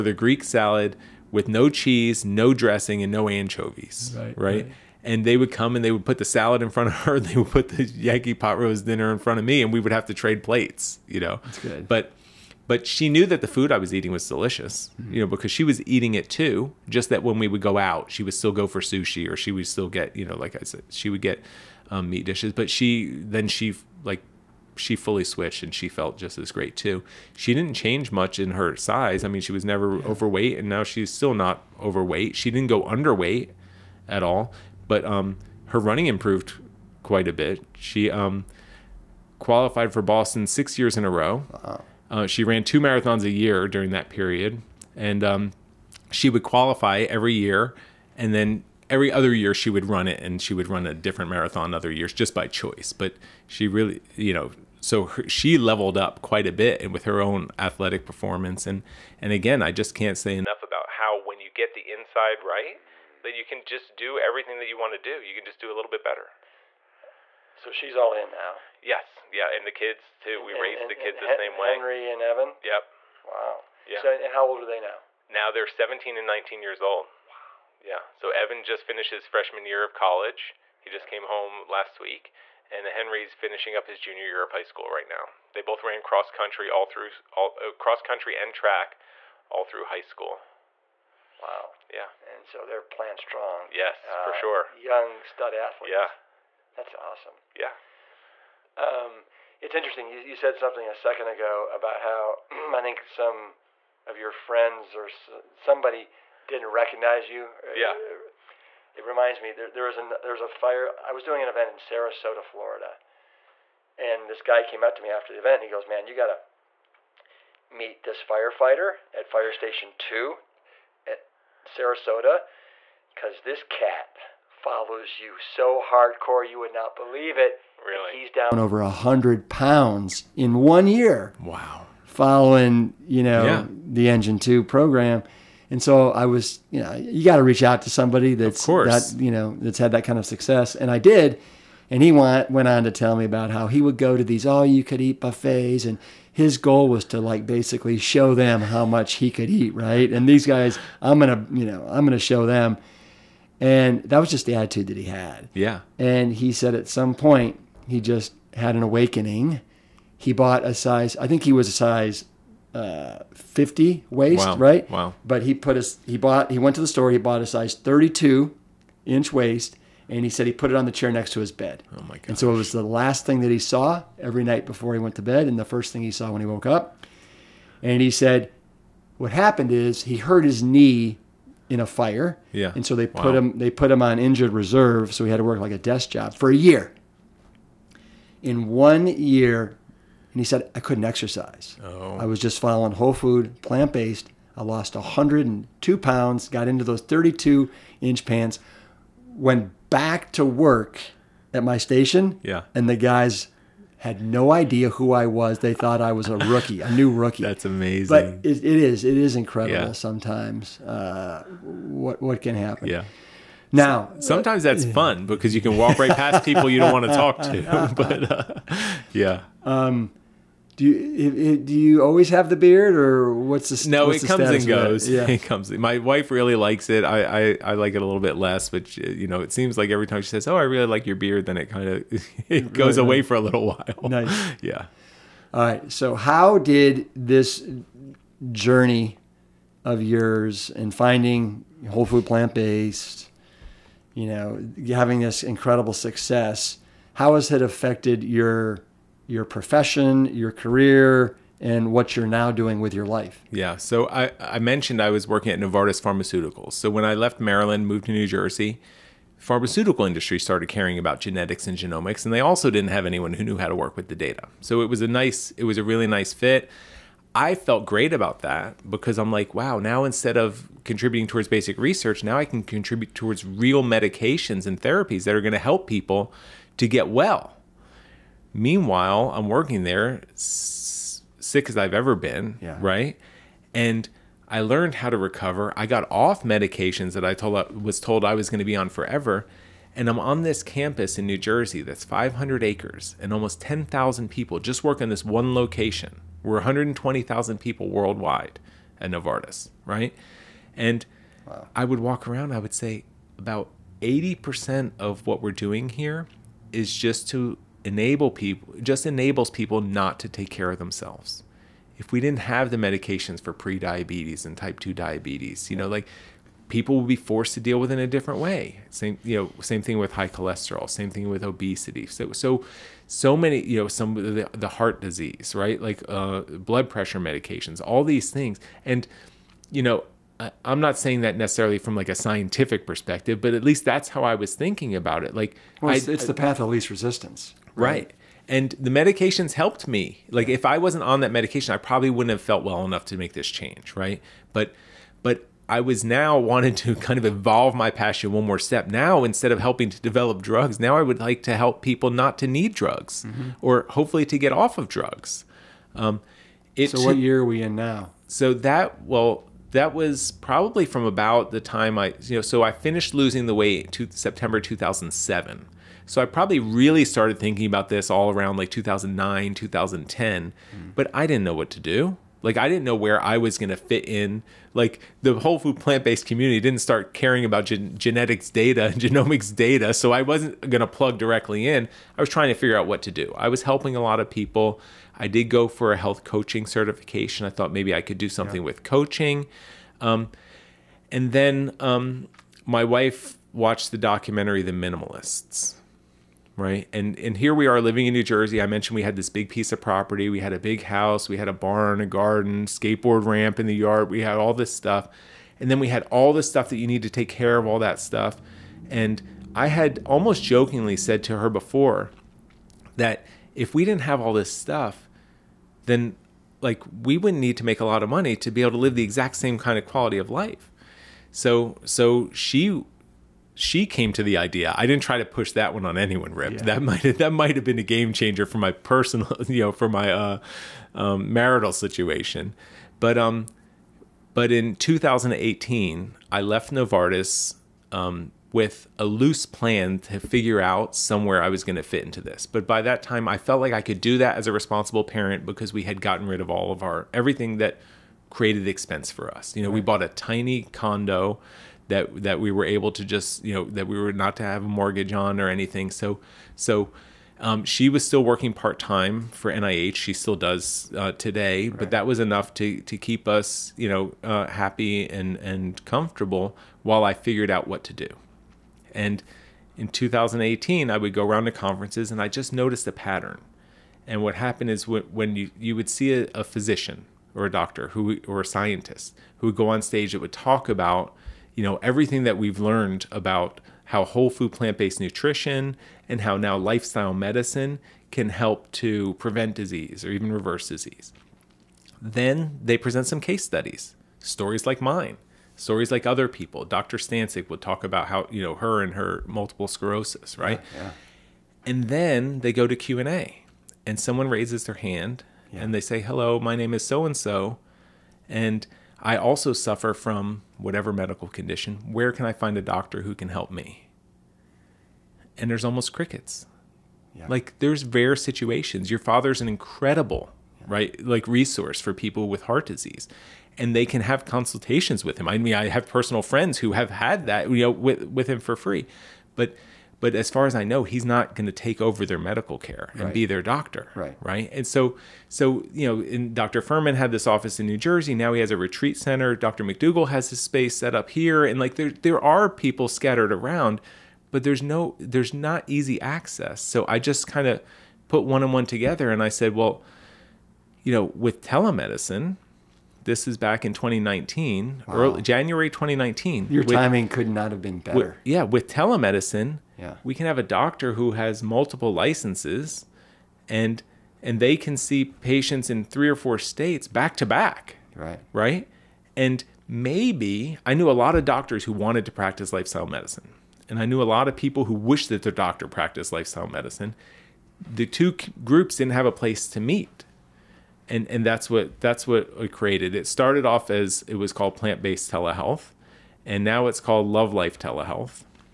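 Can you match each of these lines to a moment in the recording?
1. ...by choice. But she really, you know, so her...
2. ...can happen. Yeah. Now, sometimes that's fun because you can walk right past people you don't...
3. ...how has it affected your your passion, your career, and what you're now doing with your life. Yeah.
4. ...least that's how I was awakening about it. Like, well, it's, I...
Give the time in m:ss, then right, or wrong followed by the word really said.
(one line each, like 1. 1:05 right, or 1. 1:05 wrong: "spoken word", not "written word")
1. 0:52 right
2. 3:32 right
3. 4:07 wrong: "profession", not "passion"
4. 5:33 wrong: "thinking", not "awakening".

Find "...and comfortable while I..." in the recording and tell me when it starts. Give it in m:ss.
7:45.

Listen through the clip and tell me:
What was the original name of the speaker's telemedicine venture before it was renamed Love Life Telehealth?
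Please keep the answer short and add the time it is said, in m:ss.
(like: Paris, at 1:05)
Plant-Based Telehealth, at 9:44.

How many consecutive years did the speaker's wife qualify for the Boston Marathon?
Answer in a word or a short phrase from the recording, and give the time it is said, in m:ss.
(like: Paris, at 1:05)
6, at 0:40.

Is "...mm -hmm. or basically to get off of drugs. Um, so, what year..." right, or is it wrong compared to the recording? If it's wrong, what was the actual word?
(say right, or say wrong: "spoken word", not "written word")
wrong: "hopefully", not "basically".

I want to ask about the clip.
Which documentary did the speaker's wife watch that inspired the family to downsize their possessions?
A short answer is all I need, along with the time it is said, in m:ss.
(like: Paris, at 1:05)
The Minimalists, at 6:34.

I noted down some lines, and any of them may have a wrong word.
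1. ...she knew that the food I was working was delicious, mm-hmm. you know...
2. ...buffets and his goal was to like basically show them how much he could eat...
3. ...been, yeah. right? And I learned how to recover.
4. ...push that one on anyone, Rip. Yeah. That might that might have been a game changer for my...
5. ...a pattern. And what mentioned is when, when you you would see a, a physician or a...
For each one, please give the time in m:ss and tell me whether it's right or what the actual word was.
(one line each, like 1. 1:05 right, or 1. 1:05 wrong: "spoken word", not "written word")
1. 0:12 wrong: "eating", not "working"
2. 2:25 right
3. 4:42 right
4. 7:05 right
5. 7:52 wrong: "happened", not "mentioned".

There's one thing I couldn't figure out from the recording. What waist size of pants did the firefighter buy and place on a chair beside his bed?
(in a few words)
32 inch.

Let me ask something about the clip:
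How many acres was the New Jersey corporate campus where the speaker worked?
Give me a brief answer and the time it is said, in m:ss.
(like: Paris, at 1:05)
500, at 4:52.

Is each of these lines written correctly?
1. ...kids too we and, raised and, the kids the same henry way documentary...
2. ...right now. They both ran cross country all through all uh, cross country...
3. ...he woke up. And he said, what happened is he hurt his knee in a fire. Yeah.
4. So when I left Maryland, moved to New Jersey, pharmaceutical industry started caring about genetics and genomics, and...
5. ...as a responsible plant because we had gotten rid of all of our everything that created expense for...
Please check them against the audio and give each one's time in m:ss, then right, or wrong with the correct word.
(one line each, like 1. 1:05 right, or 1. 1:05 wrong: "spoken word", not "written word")
1. 1:09 wrong: "henry", not "documentary"
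2. 1:24 right
3. 2:56 right
4. 4:16 right
5. 7:24 wrong: "parent", not "plant".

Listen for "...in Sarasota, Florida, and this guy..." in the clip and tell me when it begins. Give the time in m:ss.
1:51.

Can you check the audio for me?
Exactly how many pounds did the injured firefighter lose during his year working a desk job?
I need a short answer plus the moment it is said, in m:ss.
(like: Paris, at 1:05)
102, at 3:14.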